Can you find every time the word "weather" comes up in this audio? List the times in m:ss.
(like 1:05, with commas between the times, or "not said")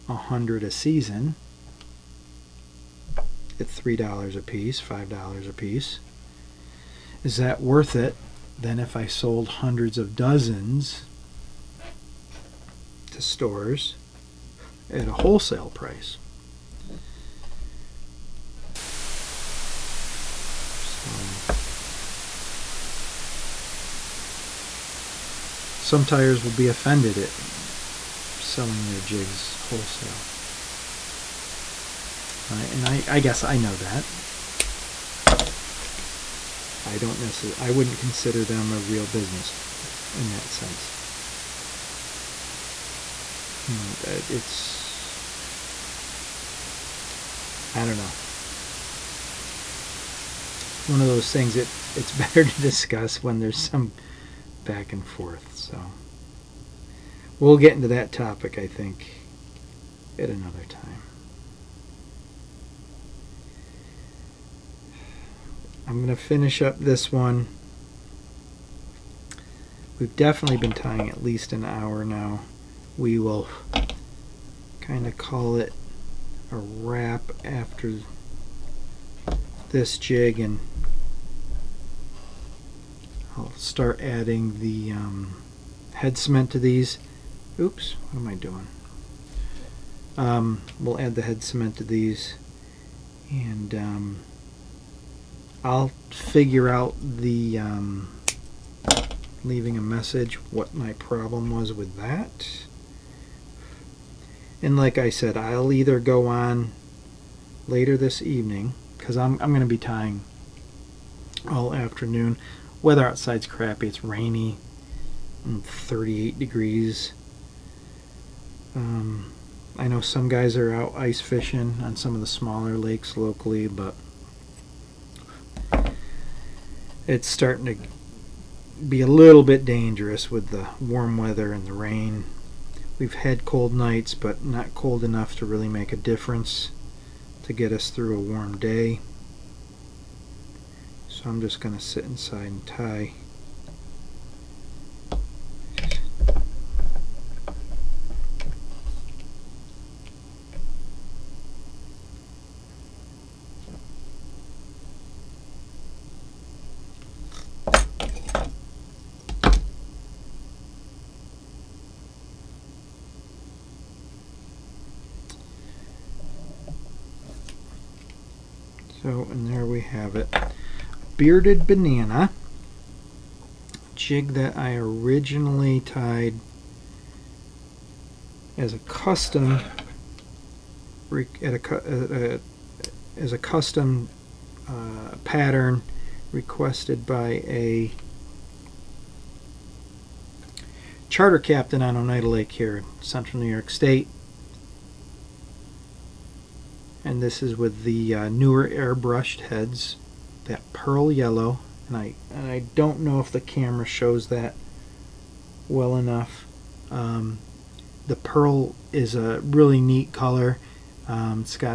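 1:52, 2:11.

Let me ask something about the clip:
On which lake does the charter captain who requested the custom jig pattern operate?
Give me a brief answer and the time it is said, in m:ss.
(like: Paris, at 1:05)
Oneida Lake, at 3:11.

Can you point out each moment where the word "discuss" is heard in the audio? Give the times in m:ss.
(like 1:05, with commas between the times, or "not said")
0:52.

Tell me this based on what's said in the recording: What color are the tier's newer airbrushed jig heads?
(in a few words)
Pearl yellow.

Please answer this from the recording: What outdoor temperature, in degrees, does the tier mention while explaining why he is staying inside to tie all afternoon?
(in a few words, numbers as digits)
38 degrees.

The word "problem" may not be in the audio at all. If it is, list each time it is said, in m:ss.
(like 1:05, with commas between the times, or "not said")
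1:40.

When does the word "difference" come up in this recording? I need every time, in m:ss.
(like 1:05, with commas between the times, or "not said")
2:15.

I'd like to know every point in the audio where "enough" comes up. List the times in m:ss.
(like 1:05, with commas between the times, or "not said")
2:15, 3:25.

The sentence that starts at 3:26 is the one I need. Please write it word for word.
Um, the pearl is a really neat color.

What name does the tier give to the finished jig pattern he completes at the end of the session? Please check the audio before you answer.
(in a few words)
Bearded banana.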